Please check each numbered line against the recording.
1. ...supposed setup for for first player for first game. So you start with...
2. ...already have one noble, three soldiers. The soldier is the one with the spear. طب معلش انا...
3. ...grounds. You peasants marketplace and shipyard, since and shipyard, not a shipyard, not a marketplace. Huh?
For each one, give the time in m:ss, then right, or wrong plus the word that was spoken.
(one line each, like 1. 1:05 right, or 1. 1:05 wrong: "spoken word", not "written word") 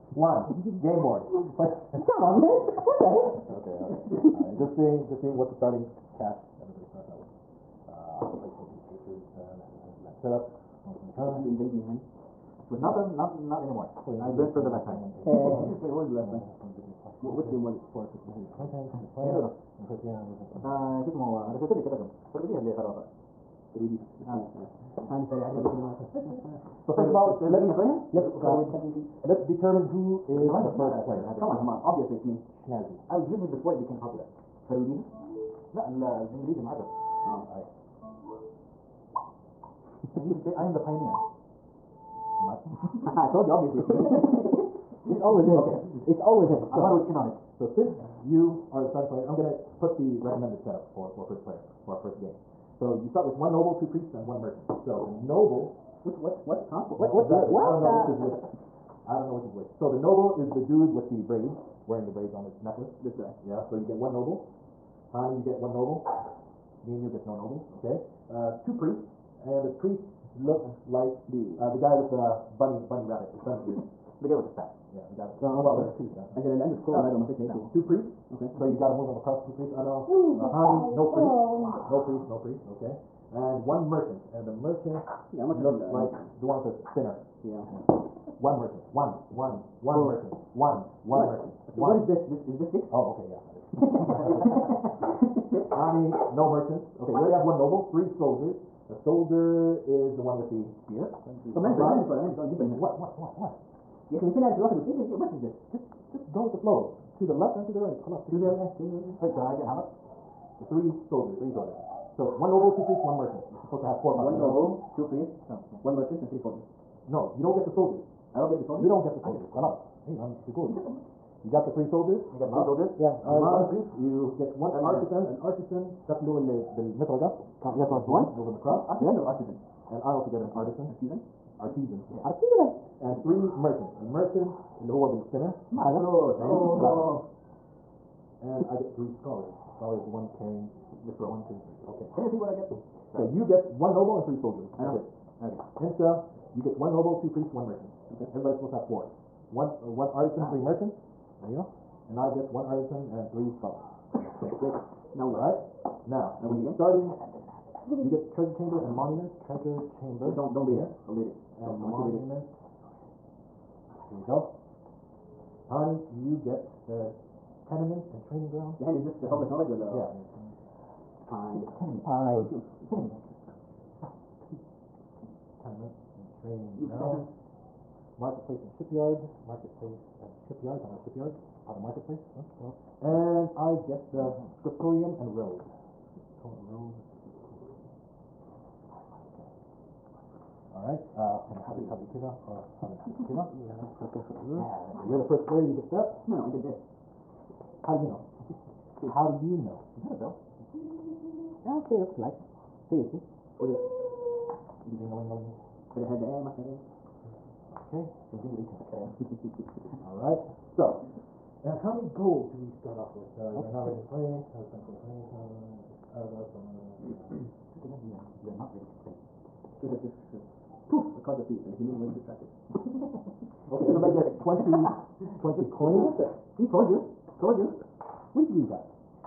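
1. 0:50 wrong: "recommended", not "supposed"
2. 1:37 right
3. 2:56 wrong: "marketplace", not "since".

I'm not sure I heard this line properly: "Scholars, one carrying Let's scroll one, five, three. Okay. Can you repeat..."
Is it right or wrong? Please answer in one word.
wrong.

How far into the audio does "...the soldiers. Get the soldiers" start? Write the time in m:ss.
1:59.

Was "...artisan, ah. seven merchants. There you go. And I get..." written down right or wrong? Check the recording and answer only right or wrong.
wrong.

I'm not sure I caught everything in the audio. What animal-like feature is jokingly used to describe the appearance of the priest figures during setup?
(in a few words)
bunny ears.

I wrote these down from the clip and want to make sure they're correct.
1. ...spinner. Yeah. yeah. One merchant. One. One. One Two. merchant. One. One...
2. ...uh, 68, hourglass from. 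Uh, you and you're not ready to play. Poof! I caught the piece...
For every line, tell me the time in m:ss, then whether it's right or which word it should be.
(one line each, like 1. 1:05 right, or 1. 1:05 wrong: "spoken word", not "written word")
1. 1:26 wrong: "Four", not "Two"
2. 3:36 wrong: "60", not "68".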